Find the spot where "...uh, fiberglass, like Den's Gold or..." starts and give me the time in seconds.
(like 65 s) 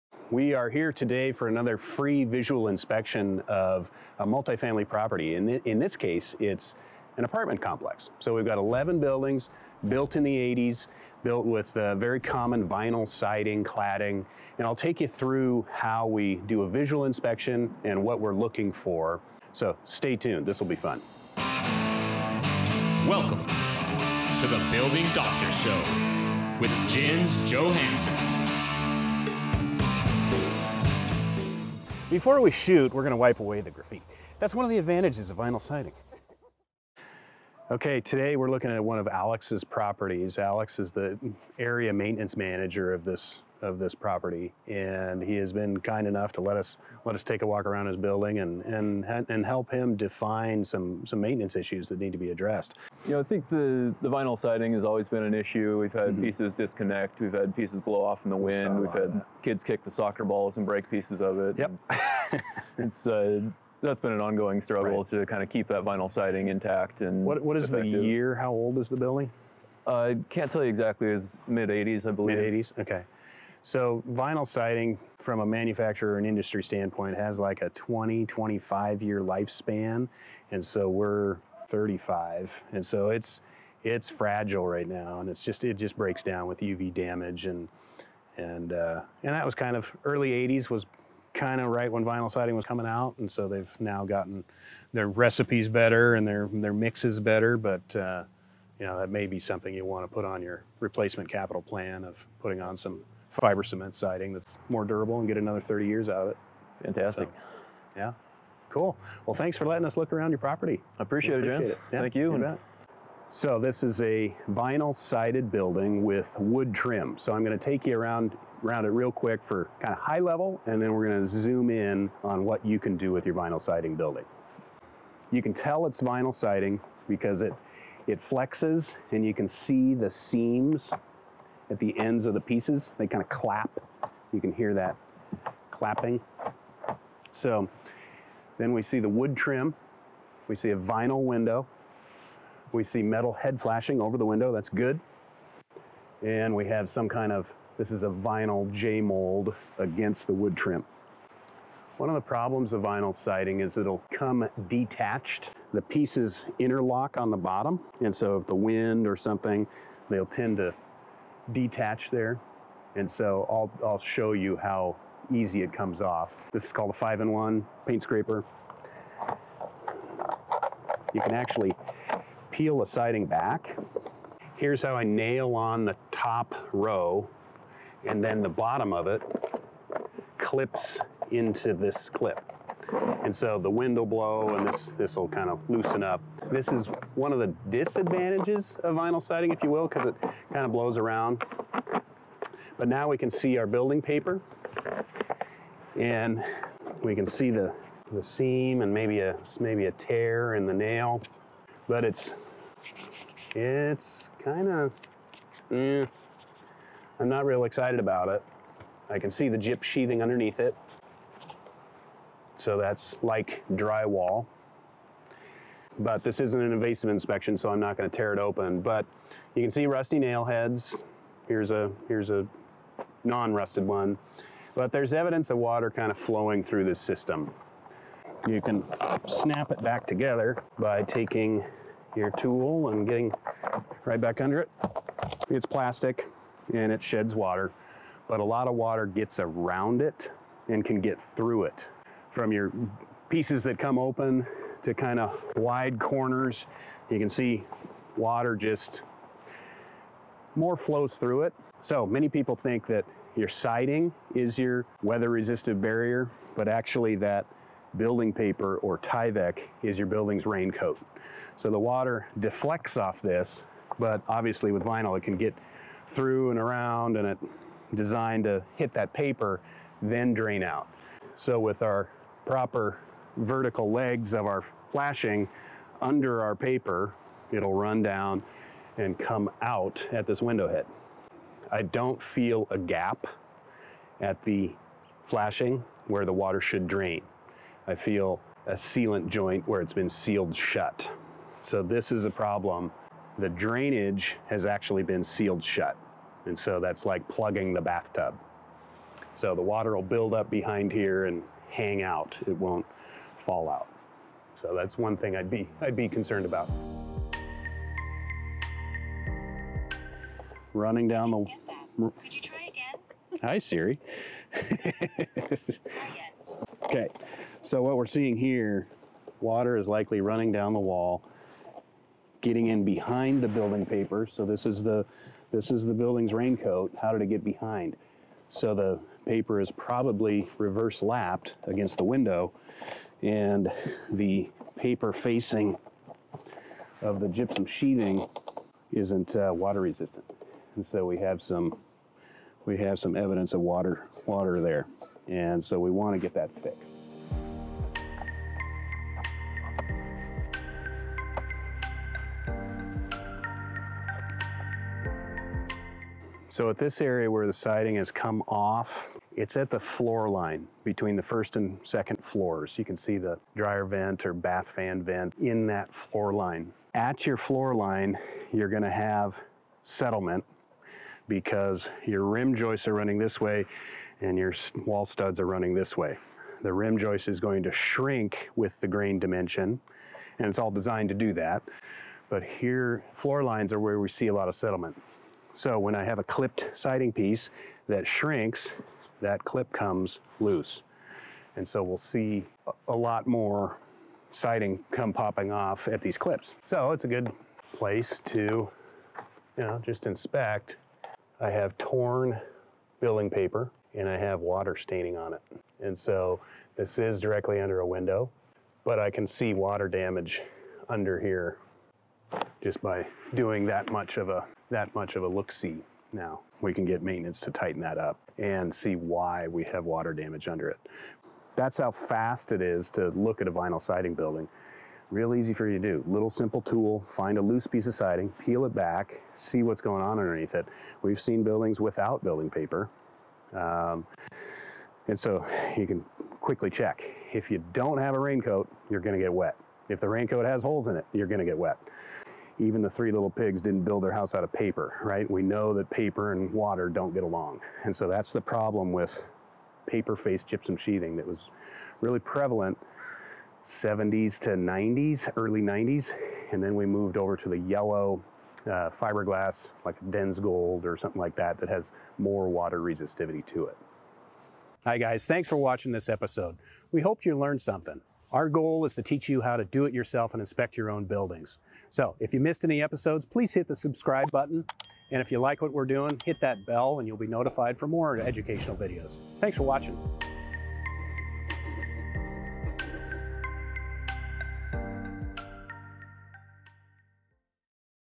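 458 s.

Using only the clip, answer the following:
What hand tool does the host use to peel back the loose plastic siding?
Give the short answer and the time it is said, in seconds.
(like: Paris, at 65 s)
5-in-1 paint scraper, at 167 s.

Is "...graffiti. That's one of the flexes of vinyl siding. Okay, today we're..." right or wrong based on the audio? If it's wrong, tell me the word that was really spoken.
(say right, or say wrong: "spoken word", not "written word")
wrong: "advantages", not "flexes".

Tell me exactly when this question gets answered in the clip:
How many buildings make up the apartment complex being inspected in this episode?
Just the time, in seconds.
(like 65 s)
8 s.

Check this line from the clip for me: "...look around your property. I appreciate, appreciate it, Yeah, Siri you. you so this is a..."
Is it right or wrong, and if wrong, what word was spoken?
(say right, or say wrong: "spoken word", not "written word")
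wrong: "Thank", not "Siri".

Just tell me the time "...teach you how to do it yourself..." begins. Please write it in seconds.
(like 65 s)
469 s.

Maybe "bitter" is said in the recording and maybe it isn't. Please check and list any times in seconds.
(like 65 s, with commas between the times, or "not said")
not said.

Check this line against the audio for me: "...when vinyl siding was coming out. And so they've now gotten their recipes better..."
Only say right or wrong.
right.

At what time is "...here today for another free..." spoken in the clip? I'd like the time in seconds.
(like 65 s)
0 s.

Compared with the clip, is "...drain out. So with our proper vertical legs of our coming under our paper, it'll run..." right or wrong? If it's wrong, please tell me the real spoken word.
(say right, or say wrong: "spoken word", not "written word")
wrong: "flashing", not "coming".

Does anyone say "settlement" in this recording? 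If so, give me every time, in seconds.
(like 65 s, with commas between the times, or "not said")
369 s, 384 s.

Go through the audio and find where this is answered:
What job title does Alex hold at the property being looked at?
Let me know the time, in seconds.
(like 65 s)
41 s.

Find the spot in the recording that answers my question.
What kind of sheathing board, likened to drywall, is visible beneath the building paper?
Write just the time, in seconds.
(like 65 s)
209 s.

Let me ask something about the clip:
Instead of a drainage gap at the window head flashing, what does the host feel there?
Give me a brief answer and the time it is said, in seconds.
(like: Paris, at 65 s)
A sealant joint, at 288 s.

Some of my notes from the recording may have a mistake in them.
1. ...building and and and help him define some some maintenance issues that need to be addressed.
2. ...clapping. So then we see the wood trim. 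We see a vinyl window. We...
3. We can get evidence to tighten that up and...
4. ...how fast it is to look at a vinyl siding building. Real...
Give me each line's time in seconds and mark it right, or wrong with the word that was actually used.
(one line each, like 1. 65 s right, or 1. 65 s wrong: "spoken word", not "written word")
1. 47 s right
2. 135 s right
3. 416 s wrong: "maintenance", not "evidence"
4. 421 s right.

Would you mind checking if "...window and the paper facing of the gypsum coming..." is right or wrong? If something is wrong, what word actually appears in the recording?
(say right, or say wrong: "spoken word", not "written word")
wrong: "sheathing", not "coming".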